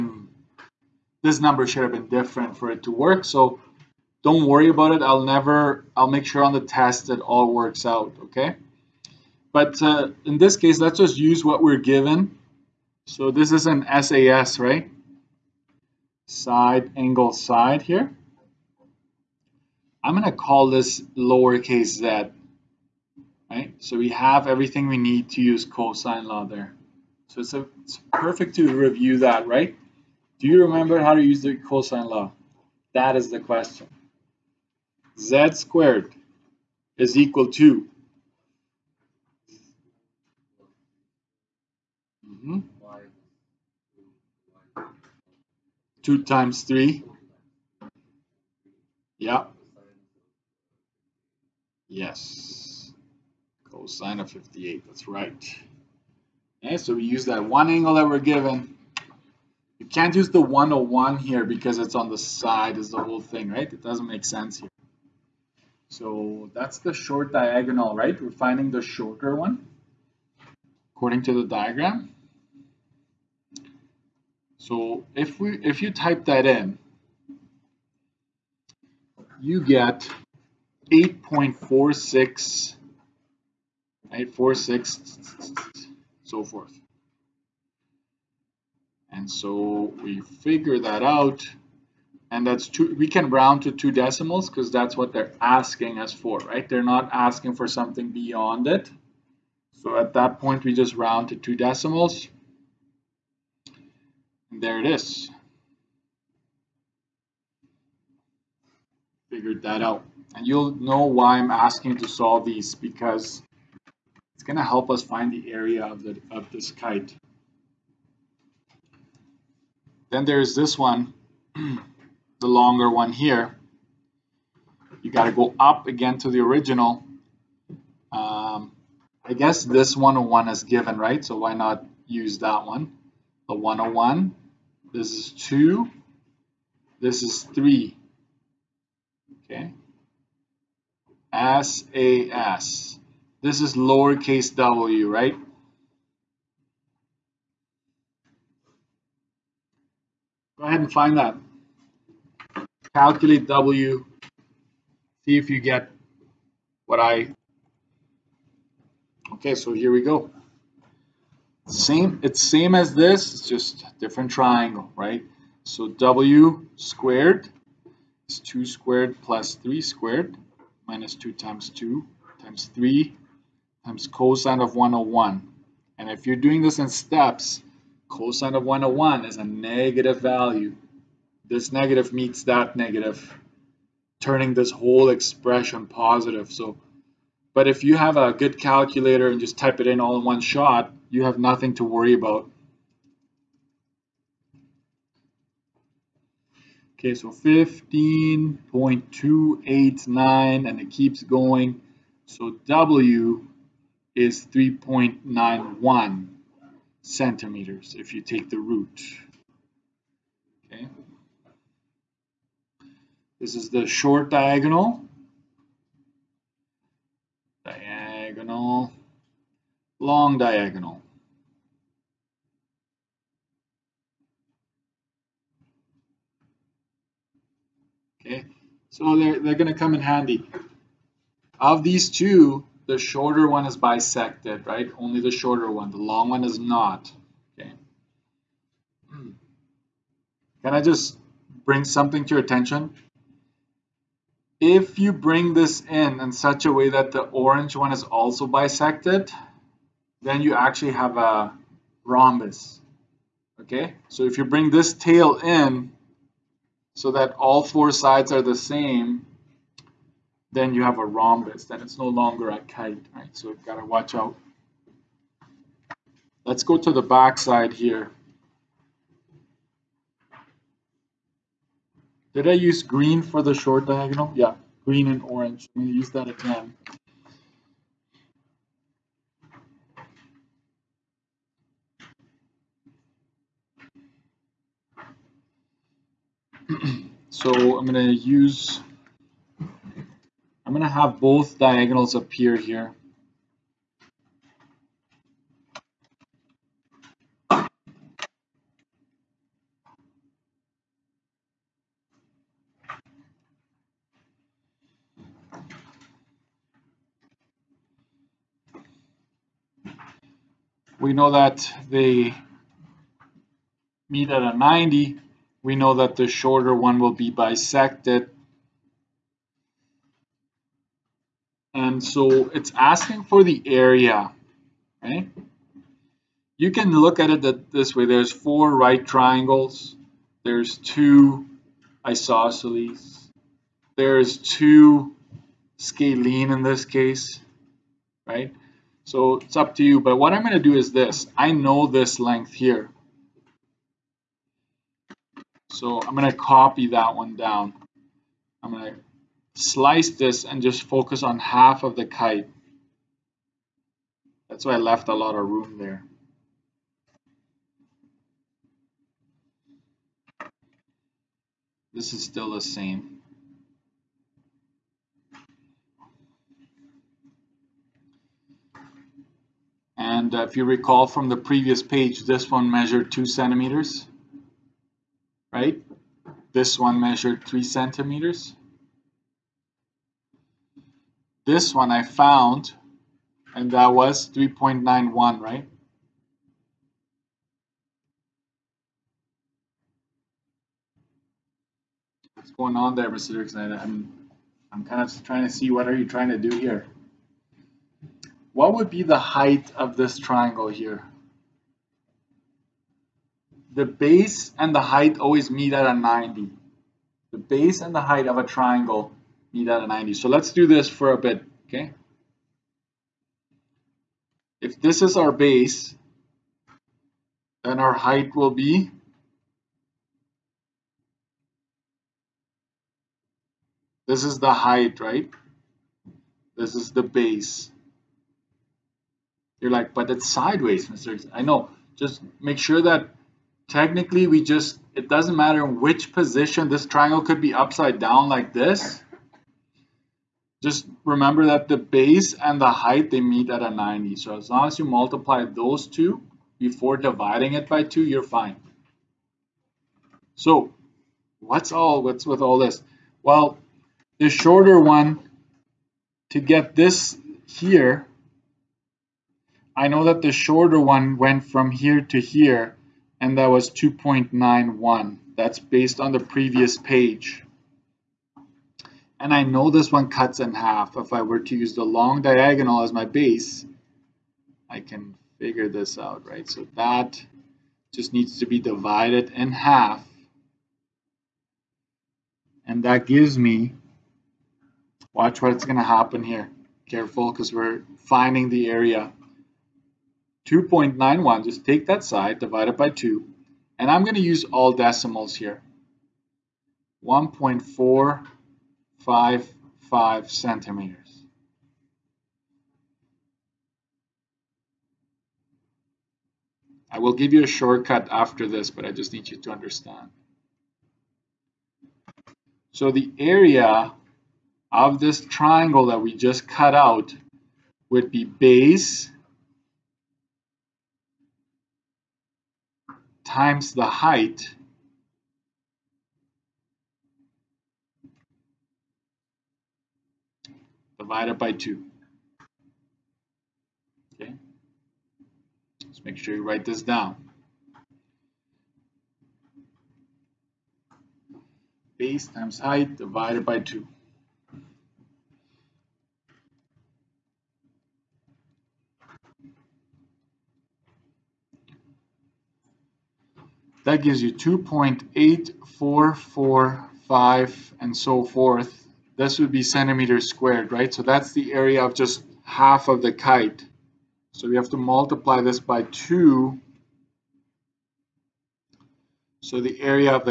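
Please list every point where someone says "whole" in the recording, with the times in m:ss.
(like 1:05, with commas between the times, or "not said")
1:03, 3:04.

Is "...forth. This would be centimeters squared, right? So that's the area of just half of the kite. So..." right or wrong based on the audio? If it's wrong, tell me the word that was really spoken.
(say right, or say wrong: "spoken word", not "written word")
right.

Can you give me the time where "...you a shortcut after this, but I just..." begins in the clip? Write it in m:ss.
8:27.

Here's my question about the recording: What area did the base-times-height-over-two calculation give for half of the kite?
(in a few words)
2.8445.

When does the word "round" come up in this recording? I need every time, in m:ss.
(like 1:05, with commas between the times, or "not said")
1:33, 1:40.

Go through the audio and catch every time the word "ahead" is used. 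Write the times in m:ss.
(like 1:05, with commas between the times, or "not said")
2:30.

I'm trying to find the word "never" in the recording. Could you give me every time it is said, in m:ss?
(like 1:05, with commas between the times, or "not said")
0:05.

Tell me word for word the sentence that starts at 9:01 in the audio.
Base times height divided by 2.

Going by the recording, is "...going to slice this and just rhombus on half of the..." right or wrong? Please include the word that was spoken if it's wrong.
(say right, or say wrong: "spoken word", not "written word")
wrong: "focus", not "rhombus".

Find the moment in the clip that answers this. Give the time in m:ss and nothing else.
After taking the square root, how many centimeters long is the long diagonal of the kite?
3:24.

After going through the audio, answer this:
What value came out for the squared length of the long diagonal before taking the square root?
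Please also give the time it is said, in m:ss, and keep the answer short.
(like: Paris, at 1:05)
15.289, at 3:17.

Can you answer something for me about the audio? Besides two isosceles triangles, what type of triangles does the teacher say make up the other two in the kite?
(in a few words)
scalene.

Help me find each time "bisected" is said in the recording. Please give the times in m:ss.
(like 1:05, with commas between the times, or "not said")
3:53, 4:08, 5:17.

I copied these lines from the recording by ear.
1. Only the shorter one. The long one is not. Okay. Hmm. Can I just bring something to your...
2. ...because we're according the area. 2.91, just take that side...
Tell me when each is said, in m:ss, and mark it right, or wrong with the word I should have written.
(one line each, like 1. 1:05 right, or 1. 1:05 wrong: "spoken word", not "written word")
1. 3:54 right
2. 8:07 wrong: "finding", not "according".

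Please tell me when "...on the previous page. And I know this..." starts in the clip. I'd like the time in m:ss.
7:45.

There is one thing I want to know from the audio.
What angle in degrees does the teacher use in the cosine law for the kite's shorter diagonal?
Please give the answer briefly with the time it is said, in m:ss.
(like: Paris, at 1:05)
58, at 0:54.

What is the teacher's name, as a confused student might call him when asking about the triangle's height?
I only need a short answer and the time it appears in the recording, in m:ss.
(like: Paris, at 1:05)
Mr. Doerksen, at 6:33.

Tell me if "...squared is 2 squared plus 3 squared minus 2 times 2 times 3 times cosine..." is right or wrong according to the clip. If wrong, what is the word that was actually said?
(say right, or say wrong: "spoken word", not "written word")
right.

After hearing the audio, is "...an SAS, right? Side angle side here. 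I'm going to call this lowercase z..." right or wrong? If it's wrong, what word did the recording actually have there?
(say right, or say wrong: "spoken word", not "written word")
right.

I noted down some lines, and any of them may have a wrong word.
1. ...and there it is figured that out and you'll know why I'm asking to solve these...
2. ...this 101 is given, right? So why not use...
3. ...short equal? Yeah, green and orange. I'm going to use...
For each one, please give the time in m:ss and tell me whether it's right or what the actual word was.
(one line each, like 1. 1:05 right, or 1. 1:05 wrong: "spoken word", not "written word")
1. 1:44 right
2. 2:09 right
3. 4:33 wrong: "diagonal", not "equal".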